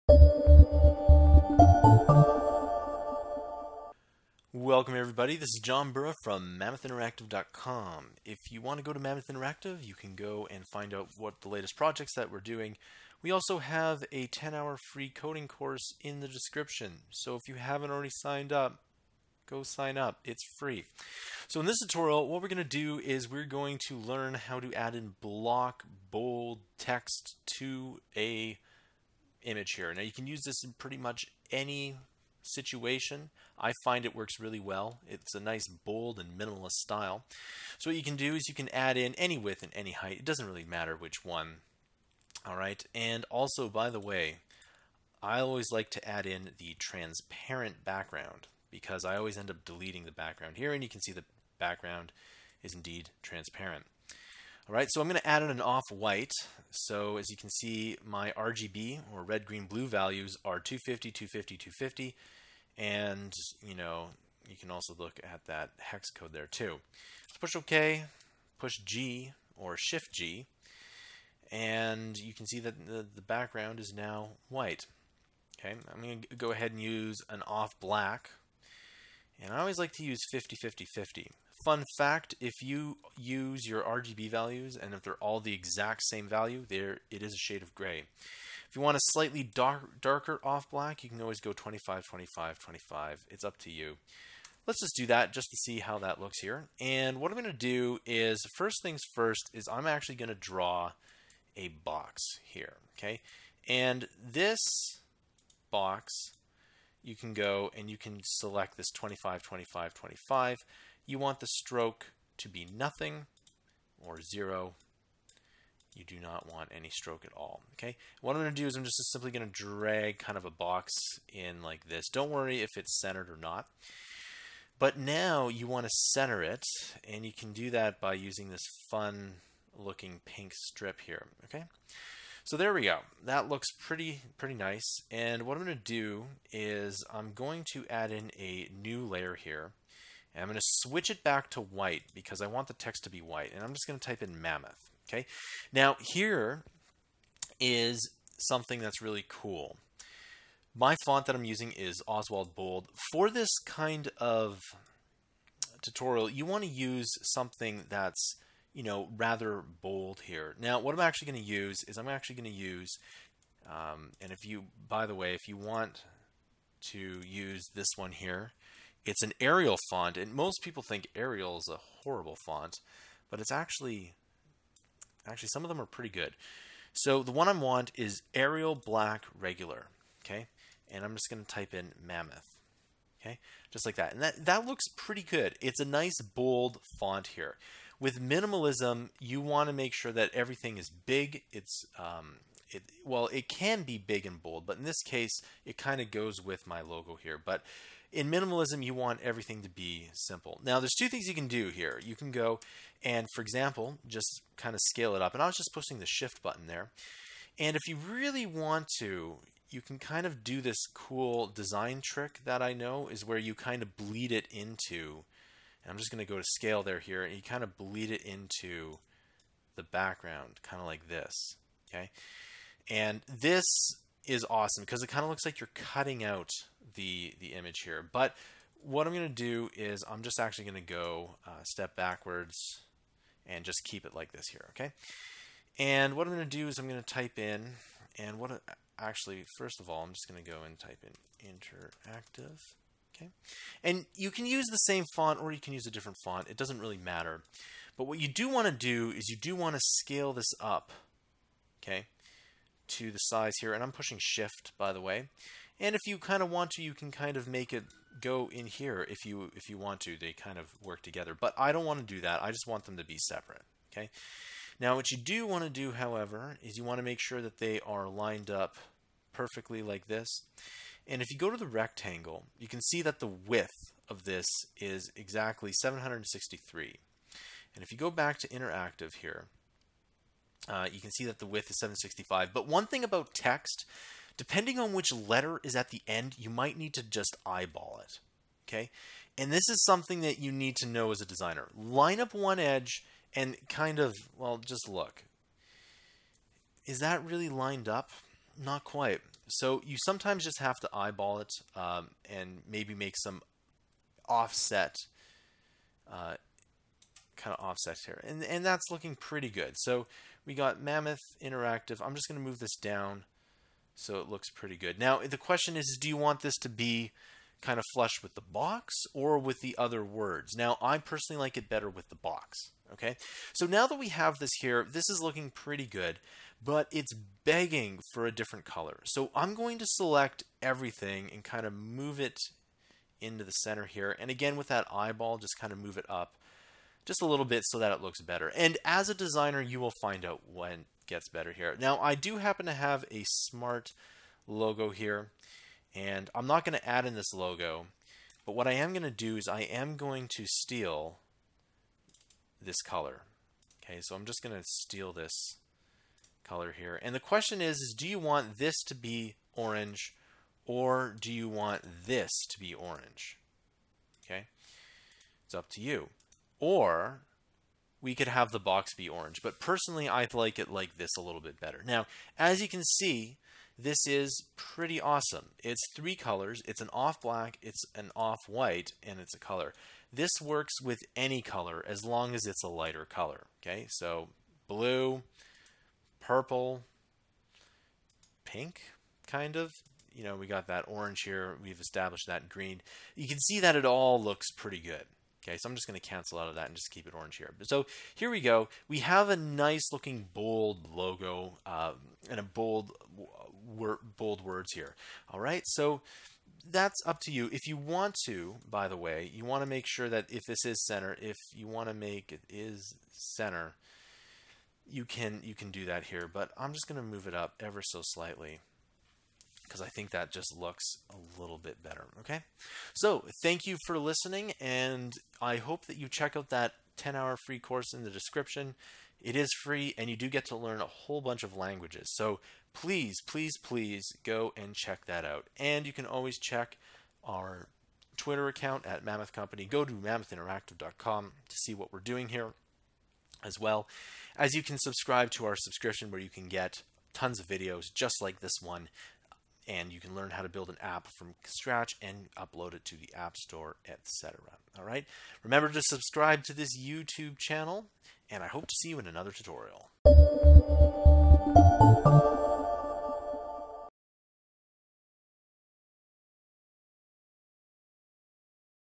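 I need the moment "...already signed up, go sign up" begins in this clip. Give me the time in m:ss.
0:17.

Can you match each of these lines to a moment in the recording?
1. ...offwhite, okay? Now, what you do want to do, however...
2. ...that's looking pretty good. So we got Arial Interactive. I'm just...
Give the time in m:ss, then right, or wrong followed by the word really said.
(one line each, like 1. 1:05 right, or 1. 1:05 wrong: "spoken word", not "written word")
1. 4:23 wrong: "separate", not "offwhite"
2. 5:08 wrong: "Mammoth", not "Arial".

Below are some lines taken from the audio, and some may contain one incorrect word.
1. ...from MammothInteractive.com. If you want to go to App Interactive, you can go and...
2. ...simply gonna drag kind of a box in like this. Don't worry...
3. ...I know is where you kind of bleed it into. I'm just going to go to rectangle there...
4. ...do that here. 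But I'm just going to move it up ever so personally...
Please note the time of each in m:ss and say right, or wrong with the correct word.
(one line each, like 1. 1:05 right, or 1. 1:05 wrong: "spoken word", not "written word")
1. 0:06 wrong: "Mammoth", not "App"
2. 1:59 right
3. 3:32 wrong: "scale", not "rectangle"
4. 6:55 wrong: "slightly", not "personally".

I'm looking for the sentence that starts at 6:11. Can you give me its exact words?
Now, as you can see, this is pretty awesome.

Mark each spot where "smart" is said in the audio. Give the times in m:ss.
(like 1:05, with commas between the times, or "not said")
5:43.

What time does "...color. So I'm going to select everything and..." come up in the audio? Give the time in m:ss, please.
5:28.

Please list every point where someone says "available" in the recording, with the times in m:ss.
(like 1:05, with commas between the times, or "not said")
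not said.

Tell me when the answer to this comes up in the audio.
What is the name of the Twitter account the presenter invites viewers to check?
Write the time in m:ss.
7:19.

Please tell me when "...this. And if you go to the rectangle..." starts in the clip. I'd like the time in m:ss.
4:30.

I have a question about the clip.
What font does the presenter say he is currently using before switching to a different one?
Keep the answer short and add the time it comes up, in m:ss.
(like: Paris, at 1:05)
Oswald Bold, at 2:32.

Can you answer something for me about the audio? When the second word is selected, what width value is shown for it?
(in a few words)
765.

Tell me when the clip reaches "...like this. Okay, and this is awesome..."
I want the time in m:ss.
3:40.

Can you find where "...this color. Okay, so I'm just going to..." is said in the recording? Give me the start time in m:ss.
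5:52.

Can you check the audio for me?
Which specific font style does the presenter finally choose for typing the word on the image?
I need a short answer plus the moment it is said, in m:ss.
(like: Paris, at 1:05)
Arial Black Regular, at 2:58.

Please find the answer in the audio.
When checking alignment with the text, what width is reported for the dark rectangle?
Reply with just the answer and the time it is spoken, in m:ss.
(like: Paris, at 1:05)
763, at 4:35.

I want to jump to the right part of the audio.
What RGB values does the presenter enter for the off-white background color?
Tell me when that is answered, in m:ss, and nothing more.
1:00.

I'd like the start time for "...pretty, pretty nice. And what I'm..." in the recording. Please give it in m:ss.
2:13.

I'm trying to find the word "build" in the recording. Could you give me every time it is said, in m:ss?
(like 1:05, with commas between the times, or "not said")
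7:30.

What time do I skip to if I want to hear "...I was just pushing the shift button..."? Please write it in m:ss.
3:25.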